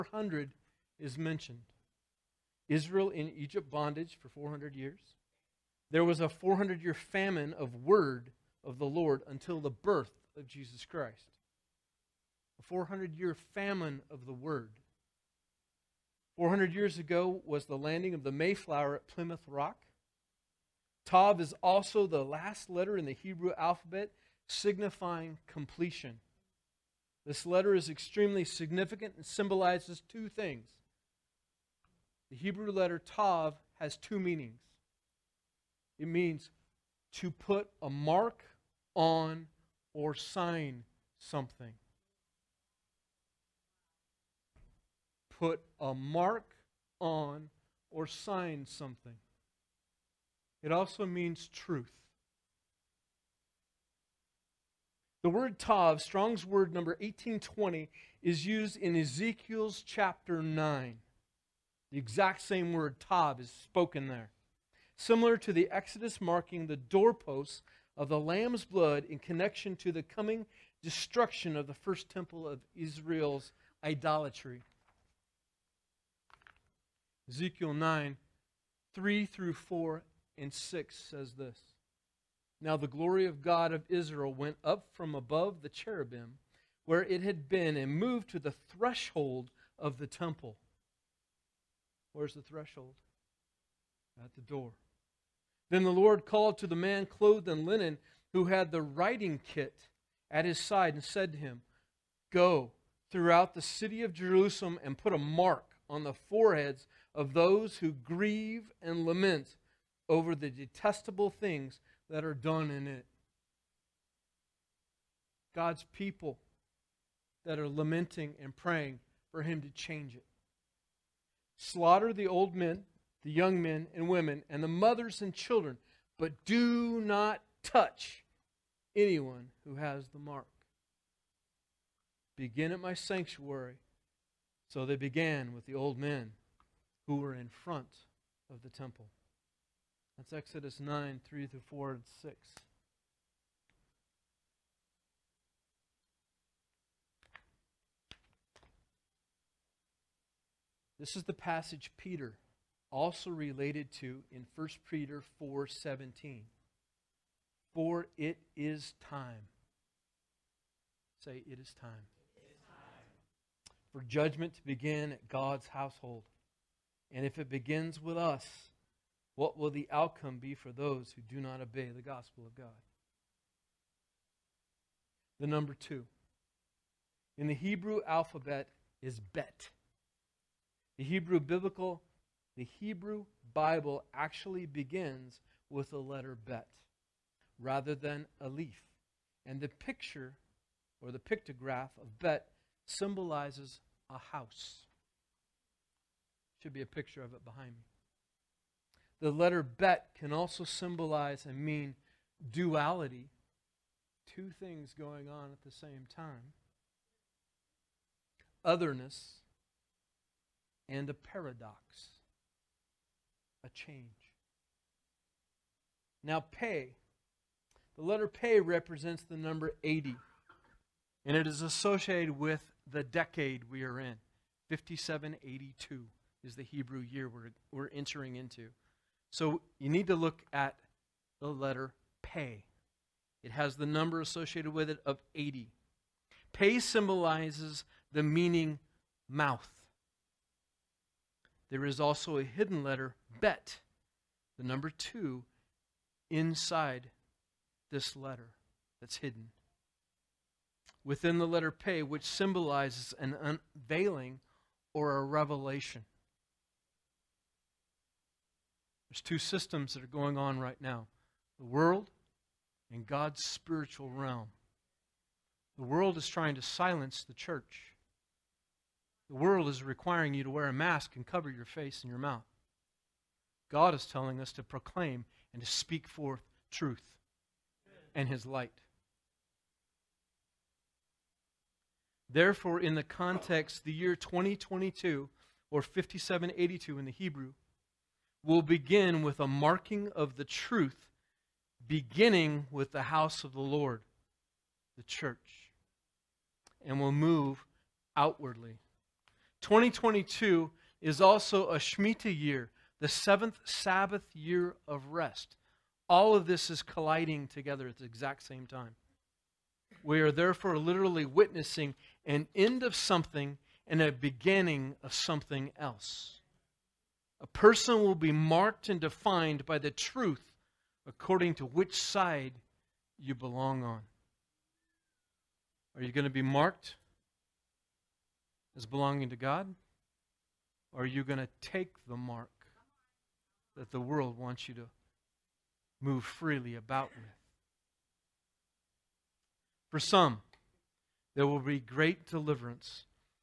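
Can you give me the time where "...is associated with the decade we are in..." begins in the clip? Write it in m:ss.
3:41.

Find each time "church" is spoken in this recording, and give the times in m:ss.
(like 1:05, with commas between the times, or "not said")
4:27, 4:55.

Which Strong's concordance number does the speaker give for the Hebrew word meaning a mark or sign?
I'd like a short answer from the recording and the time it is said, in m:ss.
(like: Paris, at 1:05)
1820, at 0:56.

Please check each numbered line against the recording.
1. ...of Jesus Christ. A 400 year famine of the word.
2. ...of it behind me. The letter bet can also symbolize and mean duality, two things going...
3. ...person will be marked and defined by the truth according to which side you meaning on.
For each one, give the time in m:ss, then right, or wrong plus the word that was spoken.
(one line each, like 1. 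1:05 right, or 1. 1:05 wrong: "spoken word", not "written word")
1. 0:10 right
2. 3:17 right
3. 5:17 wrong: "belong", not "meaning".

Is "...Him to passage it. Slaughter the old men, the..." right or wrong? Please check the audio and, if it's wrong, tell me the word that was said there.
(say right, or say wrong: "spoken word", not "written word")
wrong: "change", not "passage".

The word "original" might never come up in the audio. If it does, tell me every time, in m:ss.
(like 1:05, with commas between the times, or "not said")
not said.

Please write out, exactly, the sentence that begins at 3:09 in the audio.
And the picture or the pictograph of bet symbolizes a house.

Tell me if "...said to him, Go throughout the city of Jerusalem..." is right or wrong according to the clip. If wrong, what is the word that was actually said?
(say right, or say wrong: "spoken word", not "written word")
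right.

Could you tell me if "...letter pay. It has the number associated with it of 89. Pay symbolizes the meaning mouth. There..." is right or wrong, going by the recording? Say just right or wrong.
wrong.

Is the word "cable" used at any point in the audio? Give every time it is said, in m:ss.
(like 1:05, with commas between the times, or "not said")
not said.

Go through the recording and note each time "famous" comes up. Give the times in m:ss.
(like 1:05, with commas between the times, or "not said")
not said.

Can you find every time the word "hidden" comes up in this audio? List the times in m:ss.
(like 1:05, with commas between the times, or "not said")
4:02, 4:09.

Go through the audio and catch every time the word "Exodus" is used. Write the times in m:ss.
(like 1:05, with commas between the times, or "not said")
1:05, 2:20.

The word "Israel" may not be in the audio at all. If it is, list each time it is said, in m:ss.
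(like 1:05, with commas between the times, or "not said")
0:02, 1:12, 1:23.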